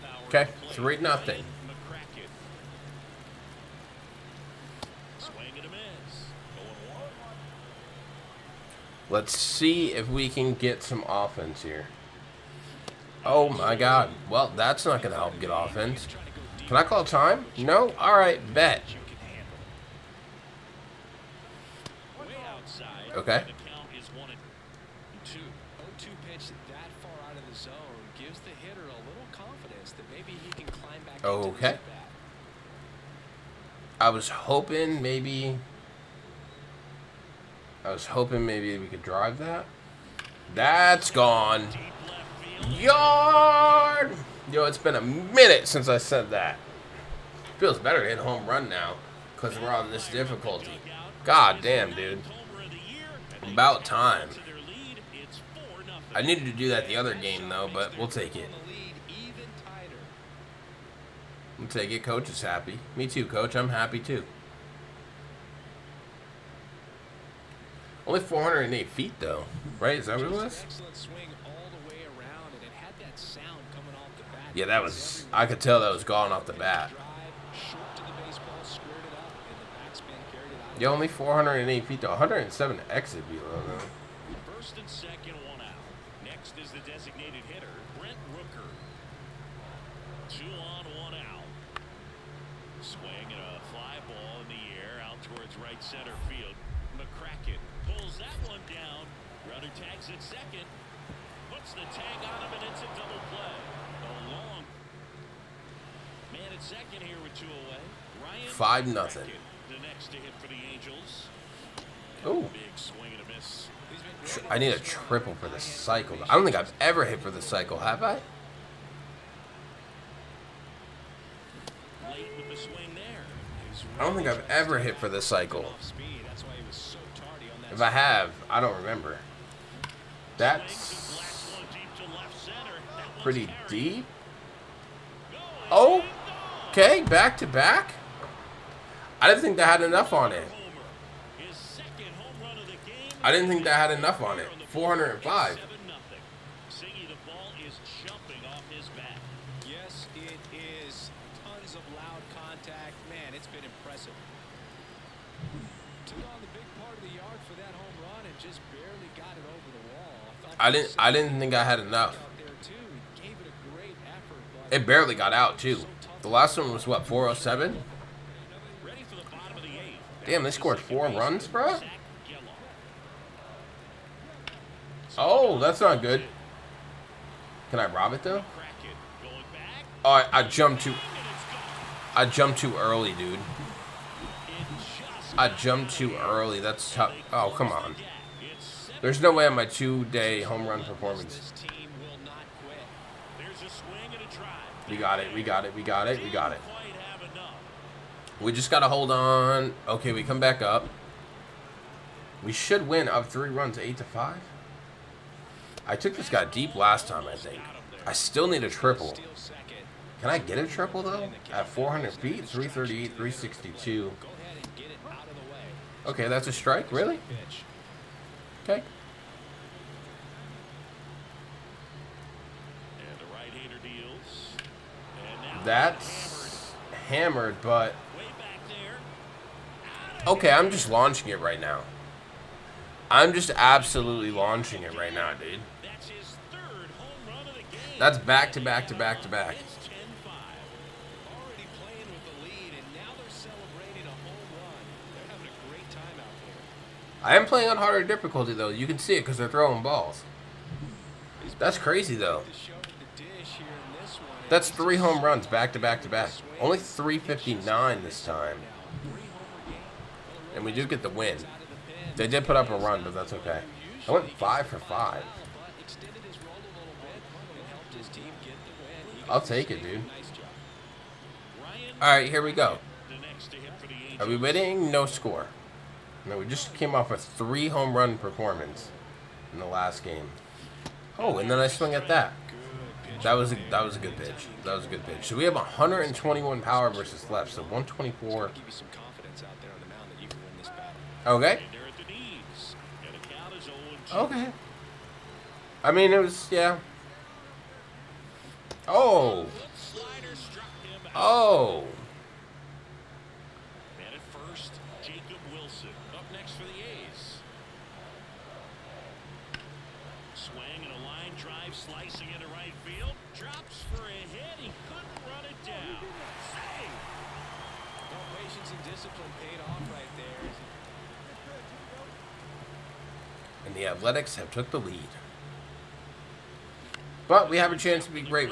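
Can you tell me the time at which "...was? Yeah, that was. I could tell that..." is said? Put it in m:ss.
1:10.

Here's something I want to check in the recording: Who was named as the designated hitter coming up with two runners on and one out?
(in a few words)
Brent Rooker.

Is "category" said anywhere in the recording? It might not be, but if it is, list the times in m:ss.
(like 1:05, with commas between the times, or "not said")
not said.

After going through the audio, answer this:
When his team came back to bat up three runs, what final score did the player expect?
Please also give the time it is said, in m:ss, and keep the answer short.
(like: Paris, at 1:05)
8 to 5, at 3:23.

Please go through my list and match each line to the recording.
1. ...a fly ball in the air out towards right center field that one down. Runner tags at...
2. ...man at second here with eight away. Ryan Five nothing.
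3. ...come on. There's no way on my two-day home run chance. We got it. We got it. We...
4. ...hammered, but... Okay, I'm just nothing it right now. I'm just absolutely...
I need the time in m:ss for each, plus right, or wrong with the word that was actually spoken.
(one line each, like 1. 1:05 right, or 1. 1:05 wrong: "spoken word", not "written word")
1. 1:33 right
2. 1:46 wrong: "two", not "eight"
3. 3:07 wrong: "performance", not "chance"
4. 3:47 wrong: "launching", not "nothing".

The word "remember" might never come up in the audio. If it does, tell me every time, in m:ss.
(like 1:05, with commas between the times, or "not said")
2:08.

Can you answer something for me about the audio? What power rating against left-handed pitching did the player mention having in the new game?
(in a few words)
124.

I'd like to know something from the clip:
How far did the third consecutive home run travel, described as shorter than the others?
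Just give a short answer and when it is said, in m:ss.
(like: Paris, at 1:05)
359 feet, at 4:16.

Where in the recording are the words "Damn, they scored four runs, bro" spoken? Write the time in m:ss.
2:50.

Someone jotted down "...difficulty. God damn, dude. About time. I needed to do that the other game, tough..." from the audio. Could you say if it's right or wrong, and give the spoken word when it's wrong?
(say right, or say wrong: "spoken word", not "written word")
wrong: "though", not "tough".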